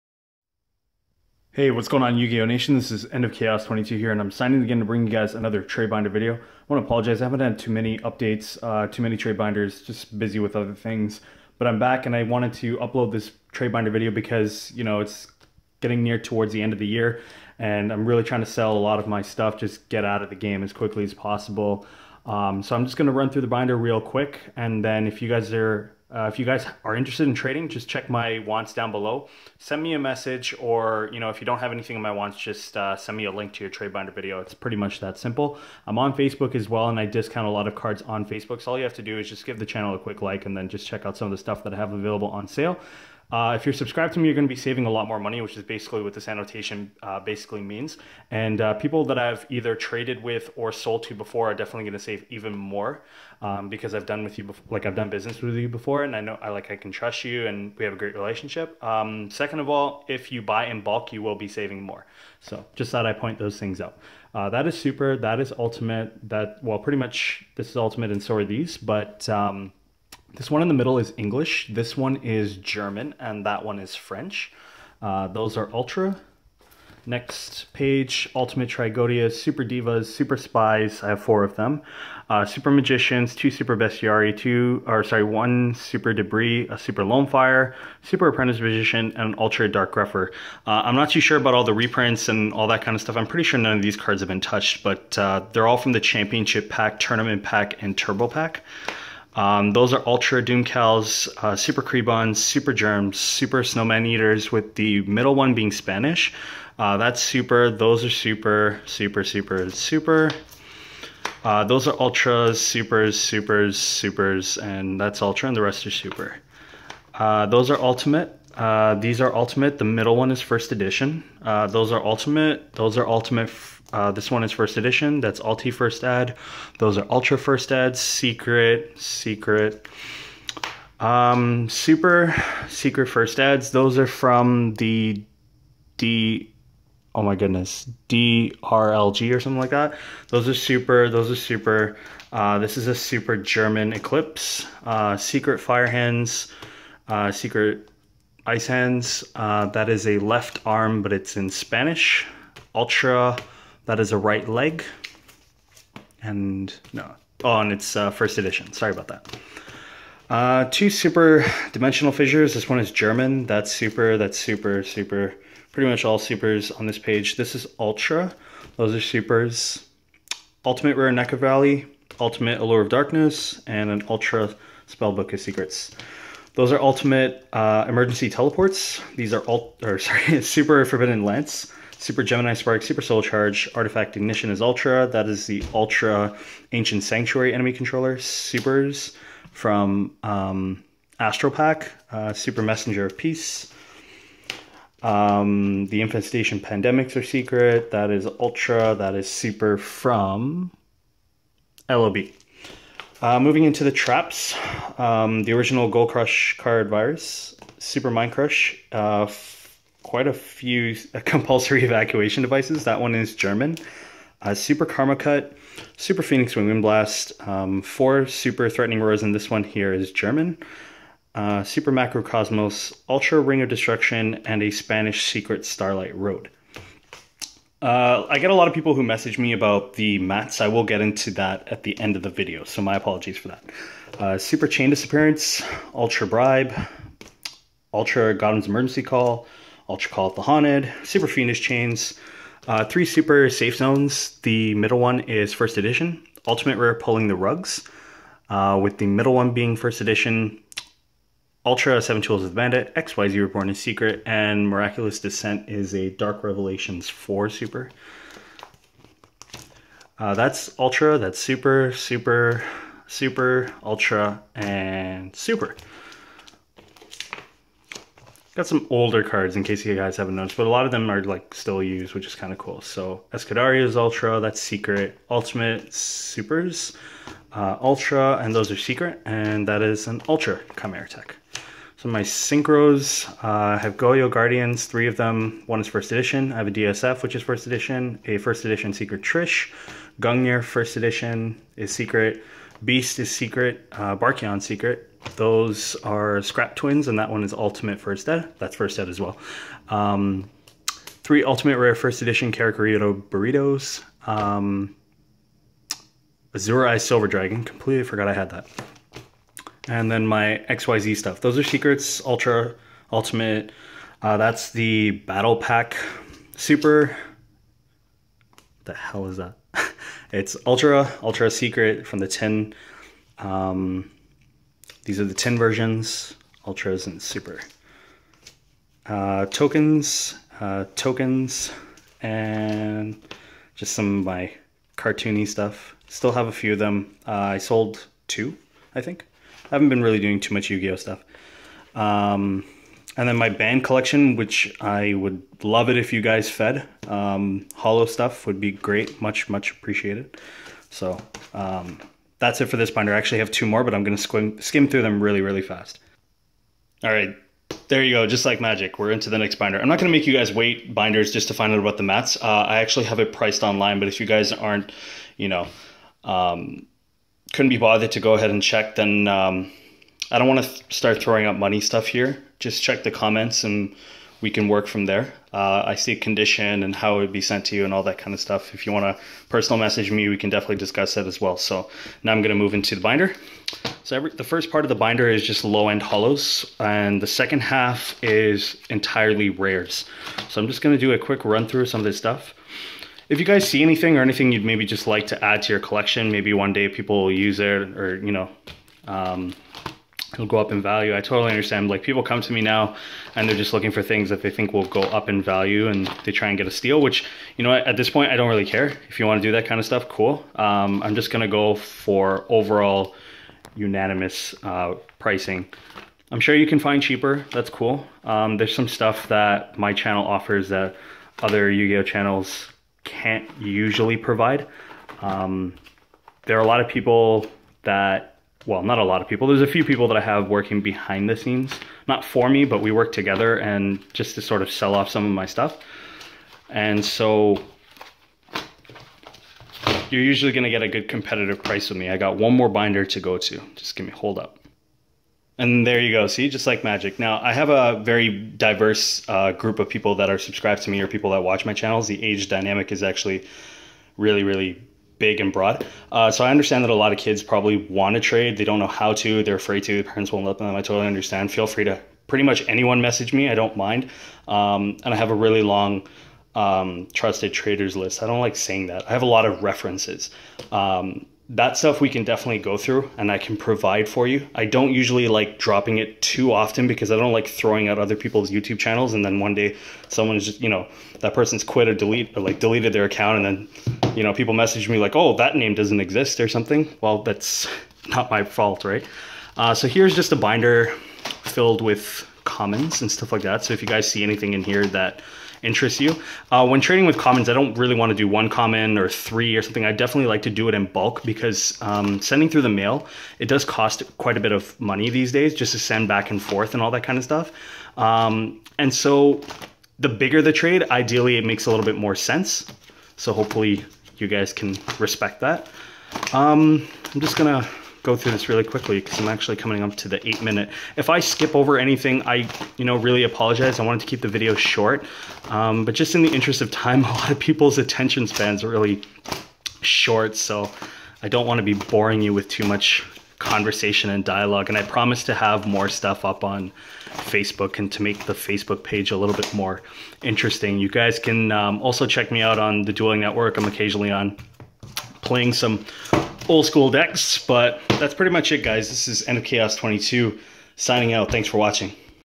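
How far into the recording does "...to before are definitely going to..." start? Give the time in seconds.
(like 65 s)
51 s.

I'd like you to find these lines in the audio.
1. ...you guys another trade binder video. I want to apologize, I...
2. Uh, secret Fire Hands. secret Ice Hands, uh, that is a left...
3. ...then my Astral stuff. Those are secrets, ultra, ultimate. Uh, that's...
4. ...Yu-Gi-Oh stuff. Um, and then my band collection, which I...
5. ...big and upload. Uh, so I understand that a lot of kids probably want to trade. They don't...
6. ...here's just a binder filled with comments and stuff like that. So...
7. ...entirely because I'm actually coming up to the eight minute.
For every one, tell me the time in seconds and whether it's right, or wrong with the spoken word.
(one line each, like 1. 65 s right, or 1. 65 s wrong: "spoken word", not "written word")
1. 5 s right
2. 144 s right
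3. 310 s wrong: "XYZ", not "Astral"
4. 340 s right
5. 455 s wrong: "broad", not "upload"
6. 489 s right
7. 518 s wrong: "quickly", not "entirely".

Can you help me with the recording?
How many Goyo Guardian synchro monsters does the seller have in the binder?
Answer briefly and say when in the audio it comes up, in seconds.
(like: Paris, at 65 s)
3, at 284 s.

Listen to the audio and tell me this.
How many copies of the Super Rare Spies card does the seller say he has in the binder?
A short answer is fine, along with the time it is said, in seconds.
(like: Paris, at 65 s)
4, at 81 s.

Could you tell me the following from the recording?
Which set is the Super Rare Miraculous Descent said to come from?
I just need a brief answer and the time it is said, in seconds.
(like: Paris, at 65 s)
Dark Revelations 4, at 256 s.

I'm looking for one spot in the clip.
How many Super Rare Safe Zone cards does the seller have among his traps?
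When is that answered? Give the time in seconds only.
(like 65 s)
242 s.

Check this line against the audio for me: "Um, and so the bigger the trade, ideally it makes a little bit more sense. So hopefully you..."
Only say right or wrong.
right.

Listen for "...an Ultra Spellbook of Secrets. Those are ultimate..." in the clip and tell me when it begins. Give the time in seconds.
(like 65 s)
173 s.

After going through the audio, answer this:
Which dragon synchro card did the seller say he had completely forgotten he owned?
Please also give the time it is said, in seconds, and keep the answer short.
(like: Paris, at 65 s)
Azura Silver Dragon, at 306 s.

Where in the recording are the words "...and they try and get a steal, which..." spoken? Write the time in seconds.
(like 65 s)
405 s.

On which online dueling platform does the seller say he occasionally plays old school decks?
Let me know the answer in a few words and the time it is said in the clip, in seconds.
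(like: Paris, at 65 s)
Dueling Network, at 542 s.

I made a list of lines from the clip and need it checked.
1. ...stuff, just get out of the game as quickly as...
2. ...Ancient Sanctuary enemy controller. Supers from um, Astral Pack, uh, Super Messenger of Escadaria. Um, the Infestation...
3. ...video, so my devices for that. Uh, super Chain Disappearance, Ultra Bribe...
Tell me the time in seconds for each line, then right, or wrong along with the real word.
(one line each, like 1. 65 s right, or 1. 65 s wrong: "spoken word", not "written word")
1. 19 s right
2. 186 s wrong: "Peace", not "Escadaria"
3. 232 s wrong: "apologies", not "devices".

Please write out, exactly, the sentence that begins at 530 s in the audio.
So I don't want to be boring you with too much conversation and dialogue.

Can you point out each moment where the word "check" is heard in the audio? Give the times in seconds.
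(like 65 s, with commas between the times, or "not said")
27 s, 40 s, 368 s, 372 s, 542 s.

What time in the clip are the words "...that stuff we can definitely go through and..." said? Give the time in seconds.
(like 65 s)
471 s.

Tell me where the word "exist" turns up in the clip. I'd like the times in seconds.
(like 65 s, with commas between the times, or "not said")
485 s.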